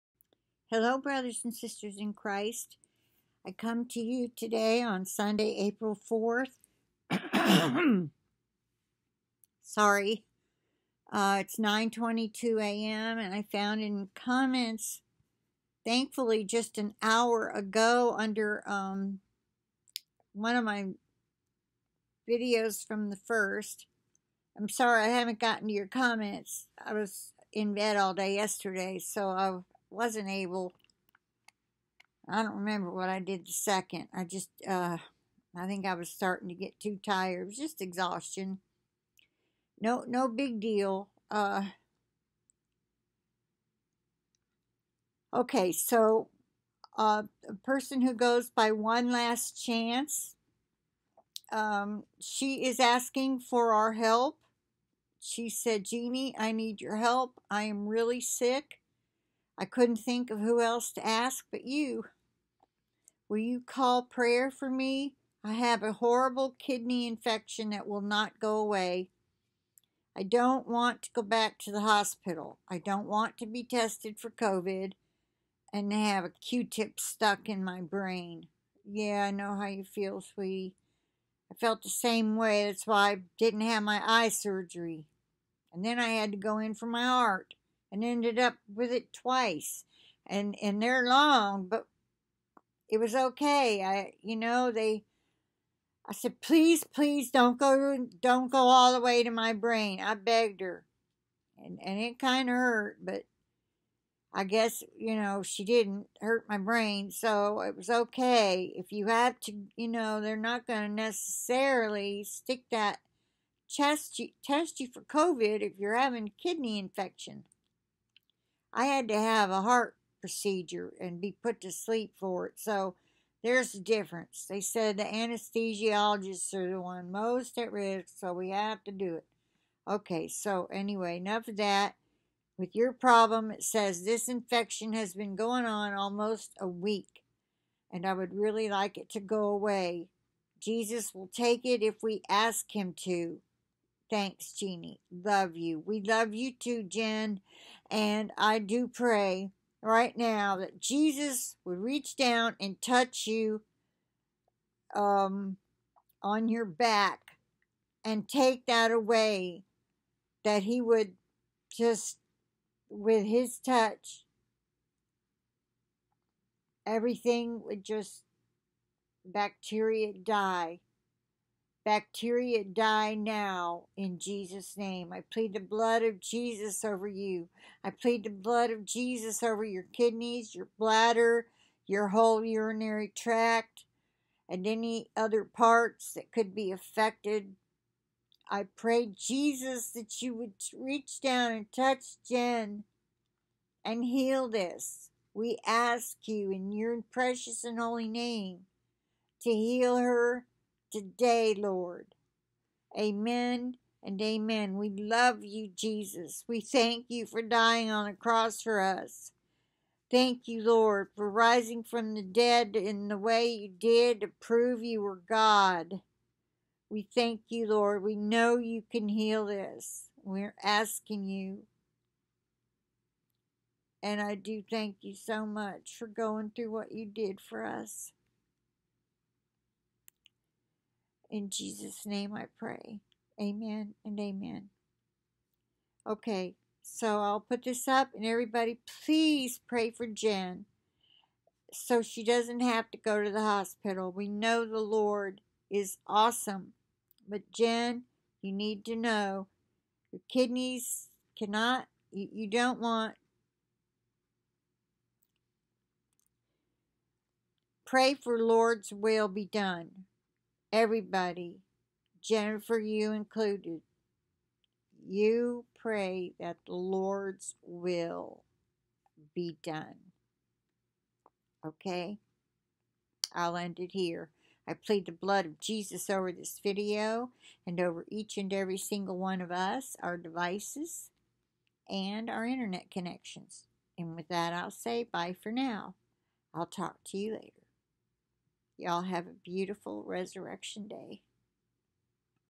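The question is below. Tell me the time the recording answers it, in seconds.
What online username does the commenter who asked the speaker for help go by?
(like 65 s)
48 s.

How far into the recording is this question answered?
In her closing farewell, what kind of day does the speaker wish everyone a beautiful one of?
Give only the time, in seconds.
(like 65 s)
290 s.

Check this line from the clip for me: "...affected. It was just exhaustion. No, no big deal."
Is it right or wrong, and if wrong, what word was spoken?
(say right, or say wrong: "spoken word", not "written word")
wrong: "tired", not "affected".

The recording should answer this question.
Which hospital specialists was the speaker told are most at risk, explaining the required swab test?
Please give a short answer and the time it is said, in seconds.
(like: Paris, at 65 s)
anesthesiologists, at 125 s.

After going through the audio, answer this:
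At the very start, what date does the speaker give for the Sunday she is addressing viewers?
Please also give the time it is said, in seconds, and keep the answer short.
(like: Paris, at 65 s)
April 4th, at 5 s.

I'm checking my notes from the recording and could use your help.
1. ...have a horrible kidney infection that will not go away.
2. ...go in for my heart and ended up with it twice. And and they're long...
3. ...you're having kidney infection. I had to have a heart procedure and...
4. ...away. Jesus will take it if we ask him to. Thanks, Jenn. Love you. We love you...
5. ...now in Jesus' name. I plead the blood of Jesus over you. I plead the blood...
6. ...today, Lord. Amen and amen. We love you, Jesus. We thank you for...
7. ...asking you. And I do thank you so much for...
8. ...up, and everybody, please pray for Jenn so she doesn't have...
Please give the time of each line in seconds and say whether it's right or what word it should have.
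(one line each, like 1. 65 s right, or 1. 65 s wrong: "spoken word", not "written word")
1. 65 s right
2. 86 s right
3. 115 s right
4. 139 s wrong: "Jeannie", not "Jenn"
5. 173 s right
6. 200 s right
7. 220 s right
8. 237 s right.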